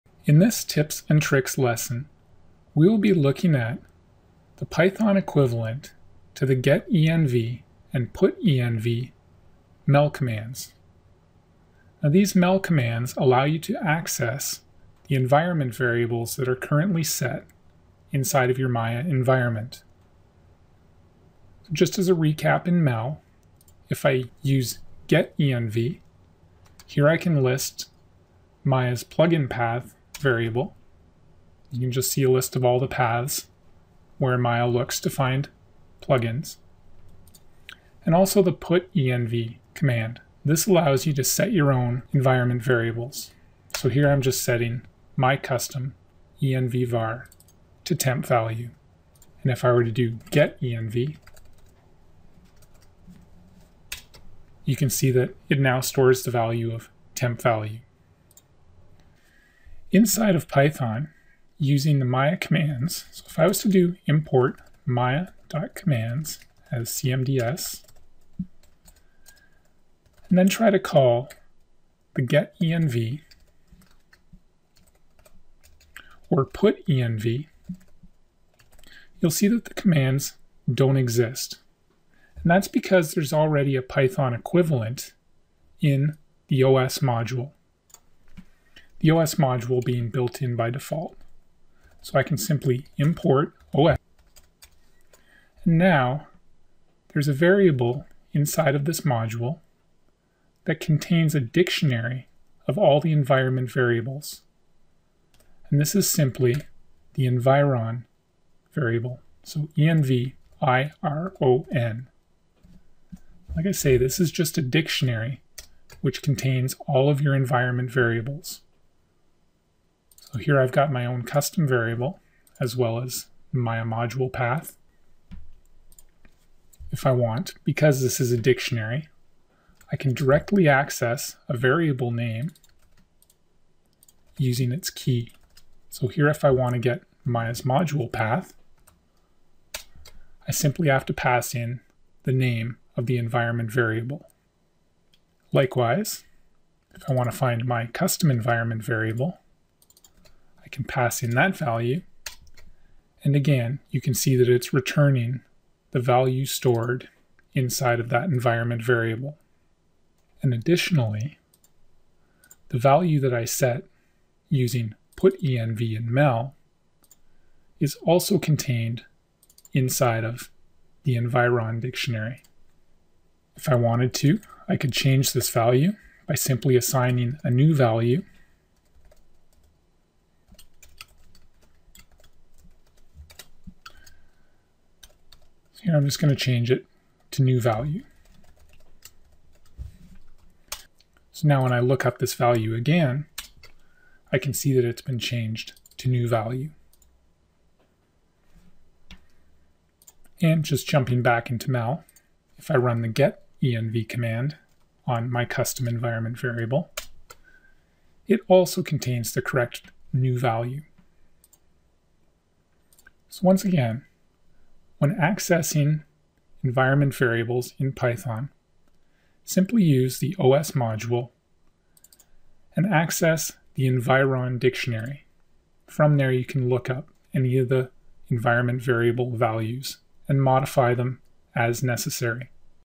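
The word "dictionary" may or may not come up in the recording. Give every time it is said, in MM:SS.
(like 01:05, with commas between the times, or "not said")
01:41, 01:54, 02:08, 02:51, 03:44.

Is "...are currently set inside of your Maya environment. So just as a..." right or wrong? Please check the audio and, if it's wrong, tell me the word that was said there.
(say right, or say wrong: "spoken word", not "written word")
right.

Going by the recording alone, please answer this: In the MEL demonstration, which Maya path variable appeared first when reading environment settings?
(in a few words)
plugin path.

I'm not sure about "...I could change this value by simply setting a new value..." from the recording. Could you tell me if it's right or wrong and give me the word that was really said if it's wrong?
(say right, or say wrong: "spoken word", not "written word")
wrong: "assigning", not "setting".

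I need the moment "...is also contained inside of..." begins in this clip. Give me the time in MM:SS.
02:47.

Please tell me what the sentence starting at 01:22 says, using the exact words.
And that's because there's already a Python equivalent in the OS module the OS module being built in by default.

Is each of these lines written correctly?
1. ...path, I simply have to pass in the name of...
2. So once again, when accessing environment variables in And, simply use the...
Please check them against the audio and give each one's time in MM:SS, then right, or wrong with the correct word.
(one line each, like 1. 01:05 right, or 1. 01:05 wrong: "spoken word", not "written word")
1. 02:18 right
2. 03:33 wrong: "Python", not "And".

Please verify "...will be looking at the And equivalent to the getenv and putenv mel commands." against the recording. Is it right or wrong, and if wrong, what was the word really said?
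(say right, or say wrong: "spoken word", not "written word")
wrong: "Python", not "And".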